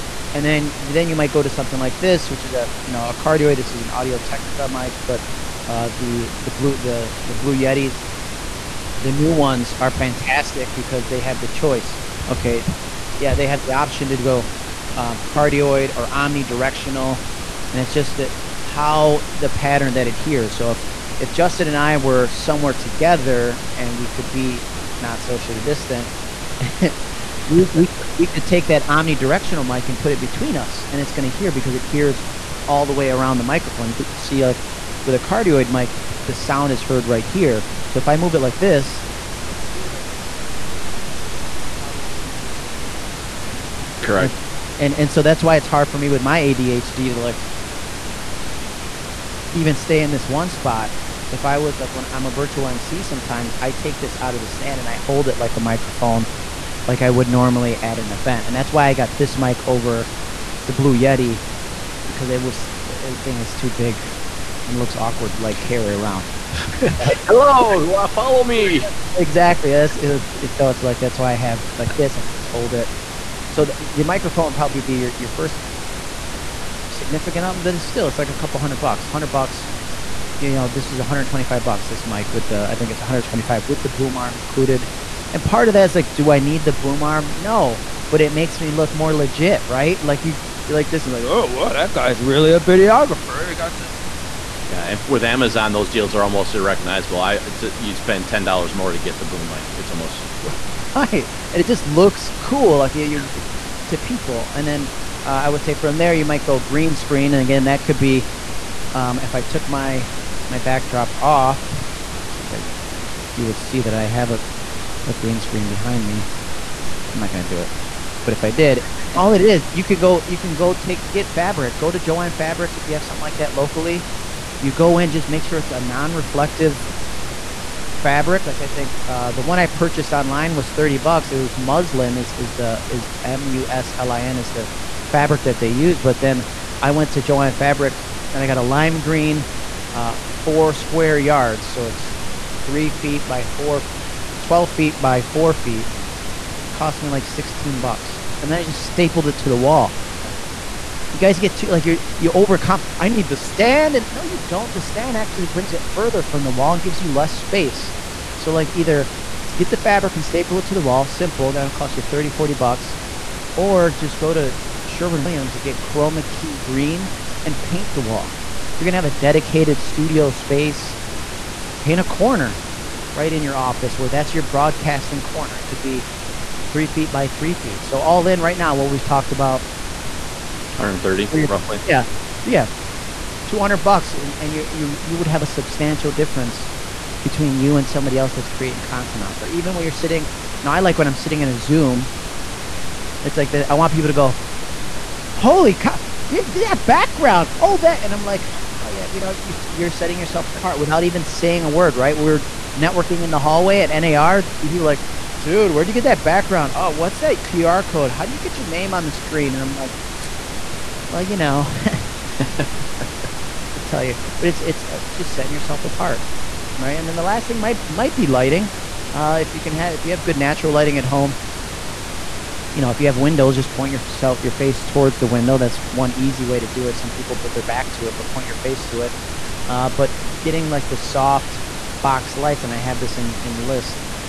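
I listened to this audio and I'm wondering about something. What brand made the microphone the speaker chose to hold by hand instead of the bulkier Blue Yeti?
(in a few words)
Audio Technica.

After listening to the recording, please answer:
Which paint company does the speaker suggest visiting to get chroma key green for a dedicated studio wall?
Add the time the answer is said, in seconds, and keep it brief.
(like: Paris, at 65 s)
Sherwin Williams, at 164 s.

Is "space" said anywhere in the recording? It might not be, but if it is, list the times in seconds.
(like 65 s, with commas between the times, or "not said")
157 s, 170 s.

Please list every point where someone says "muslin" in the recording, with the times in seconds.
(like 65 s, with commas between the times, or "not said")
131 s.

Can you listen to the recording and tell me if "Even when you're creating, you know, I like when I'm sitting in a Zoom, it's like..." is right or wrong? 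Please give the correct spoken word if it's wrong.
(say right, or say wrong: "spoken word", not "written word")
wrong: "sitting", not "creating".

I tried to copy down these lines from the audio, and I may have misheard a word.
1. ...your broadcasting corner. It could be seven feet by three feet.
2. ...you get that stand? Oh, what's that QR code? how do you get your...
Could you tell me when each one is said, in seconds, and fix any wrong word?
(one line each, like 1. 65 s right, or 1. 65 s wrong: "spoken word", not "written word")
1. 174 s wrong: "three", not "seven"
2. 205 s wrong: "background", not "stand".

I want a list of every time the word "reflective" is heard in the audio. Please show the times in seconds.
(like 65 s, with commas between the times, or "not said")
125 s.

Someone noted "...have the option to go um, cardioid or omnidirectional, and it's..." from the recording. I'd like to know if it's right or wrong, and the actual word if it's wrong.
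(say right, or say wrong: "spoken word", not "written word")
right.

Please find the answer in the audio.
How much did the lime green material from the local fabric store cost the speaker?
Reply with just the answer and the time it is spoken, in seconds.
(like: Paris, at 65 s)
$16, at 147 s.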